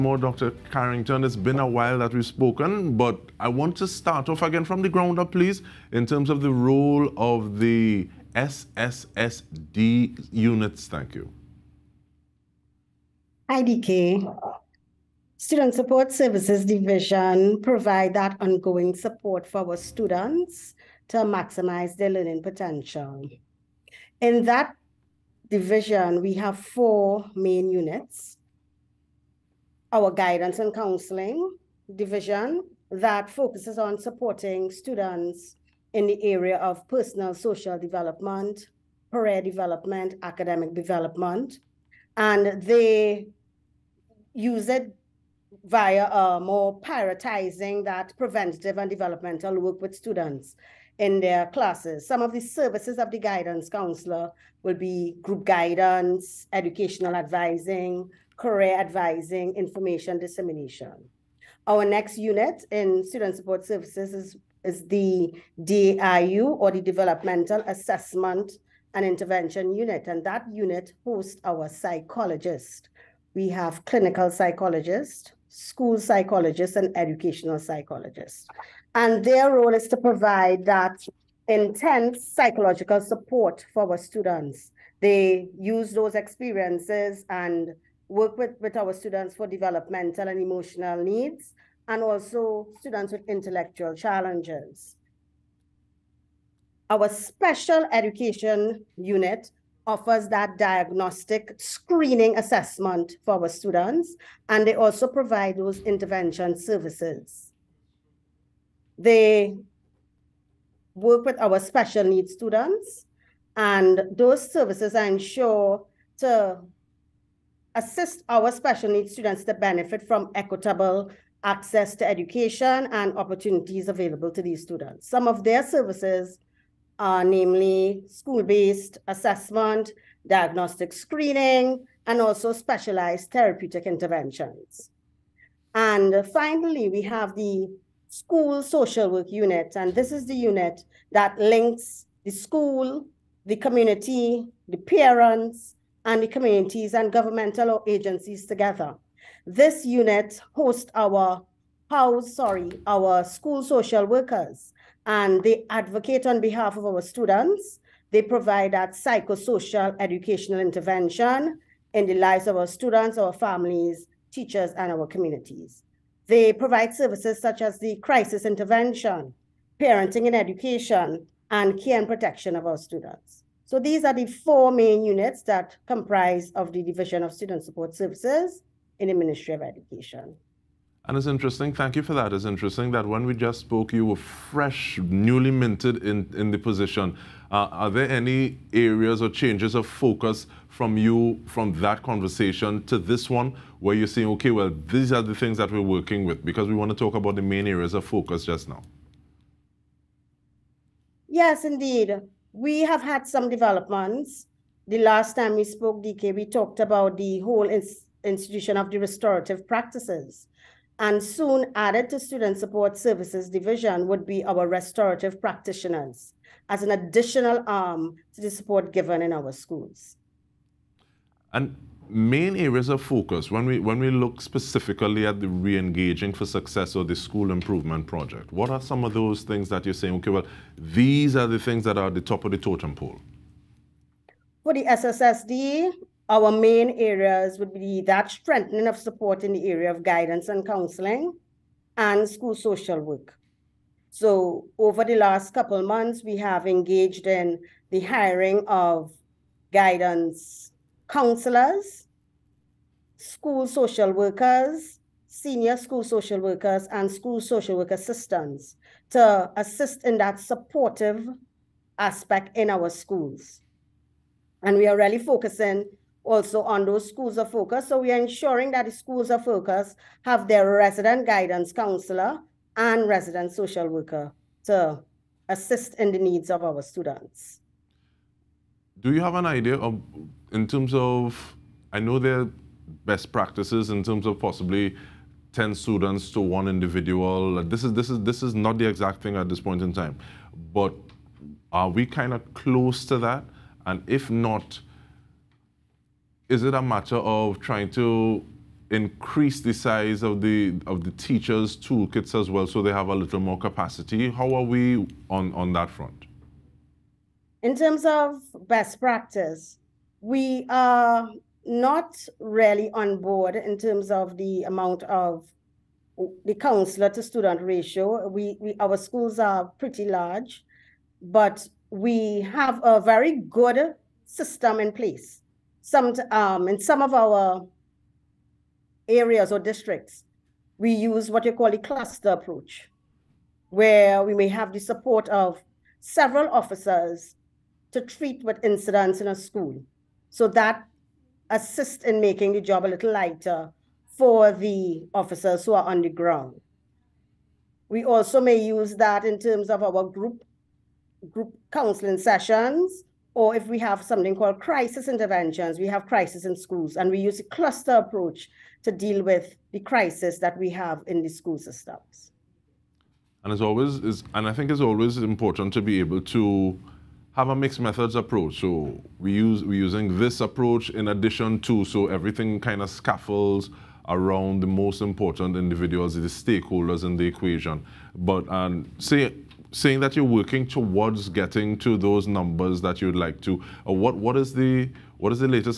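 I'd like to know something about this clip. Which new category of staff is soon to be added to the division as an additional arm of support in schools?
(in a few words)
restorative practitioners.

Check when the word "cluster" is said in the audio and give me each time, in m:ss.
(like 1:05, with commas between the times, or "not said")
5:31, 5:57.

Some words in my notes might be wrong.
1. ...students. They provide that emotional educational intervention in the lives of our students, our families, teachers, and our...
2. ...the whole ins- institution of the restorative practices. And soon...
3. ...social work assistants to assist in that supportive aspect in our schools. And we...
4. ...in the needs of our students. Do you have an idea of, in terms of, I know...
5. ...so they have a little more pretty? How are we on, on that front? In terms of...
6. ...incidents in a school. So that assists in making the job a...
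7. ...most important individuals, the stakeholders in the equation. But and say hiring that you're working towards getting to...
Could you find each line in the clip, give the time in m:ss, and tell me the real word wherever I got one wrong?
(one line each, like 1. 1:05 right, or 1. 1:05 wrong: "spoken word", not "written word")
1. 2:37 wrong: "psychosocial", not "emotional"
2. 3:27 right
3. 4:17 right
4. 4:35 right
5. 5:02 wrong: "capacity", not "pretty"
6. 5:38 right
7. 6:14 wrong: "saying", not "hiring".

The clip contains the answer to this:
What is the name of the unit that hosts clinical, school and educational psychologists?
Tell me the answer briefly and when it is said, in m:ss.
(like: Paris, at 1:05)
Developmental Assessment and Intervention Unit, at 1:06.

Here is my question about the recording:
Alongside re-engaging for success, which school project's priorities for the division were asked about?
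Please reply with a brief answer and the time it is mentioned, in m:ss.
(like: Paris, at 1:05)
school improvement project, at 3:47.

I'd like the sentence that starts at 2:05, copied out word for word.
Some of their services are namely school-based assessment, diagnostic screening, and also specialized therapeutic interventions.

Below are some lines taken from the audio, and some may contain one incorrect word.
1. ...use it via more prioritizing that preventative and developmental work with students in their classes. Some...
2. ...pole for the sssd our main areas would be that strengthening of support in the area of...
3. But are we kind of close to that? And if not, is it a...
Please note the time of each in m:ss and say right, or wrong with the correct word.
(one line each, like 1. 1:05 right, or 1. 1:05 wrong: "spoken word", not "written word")
1. 0:44 right
2. 3:52 right
3. 4:50 right.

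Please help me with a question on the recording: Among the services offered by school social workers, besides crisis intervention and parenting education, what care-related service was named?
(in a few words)
care and protection.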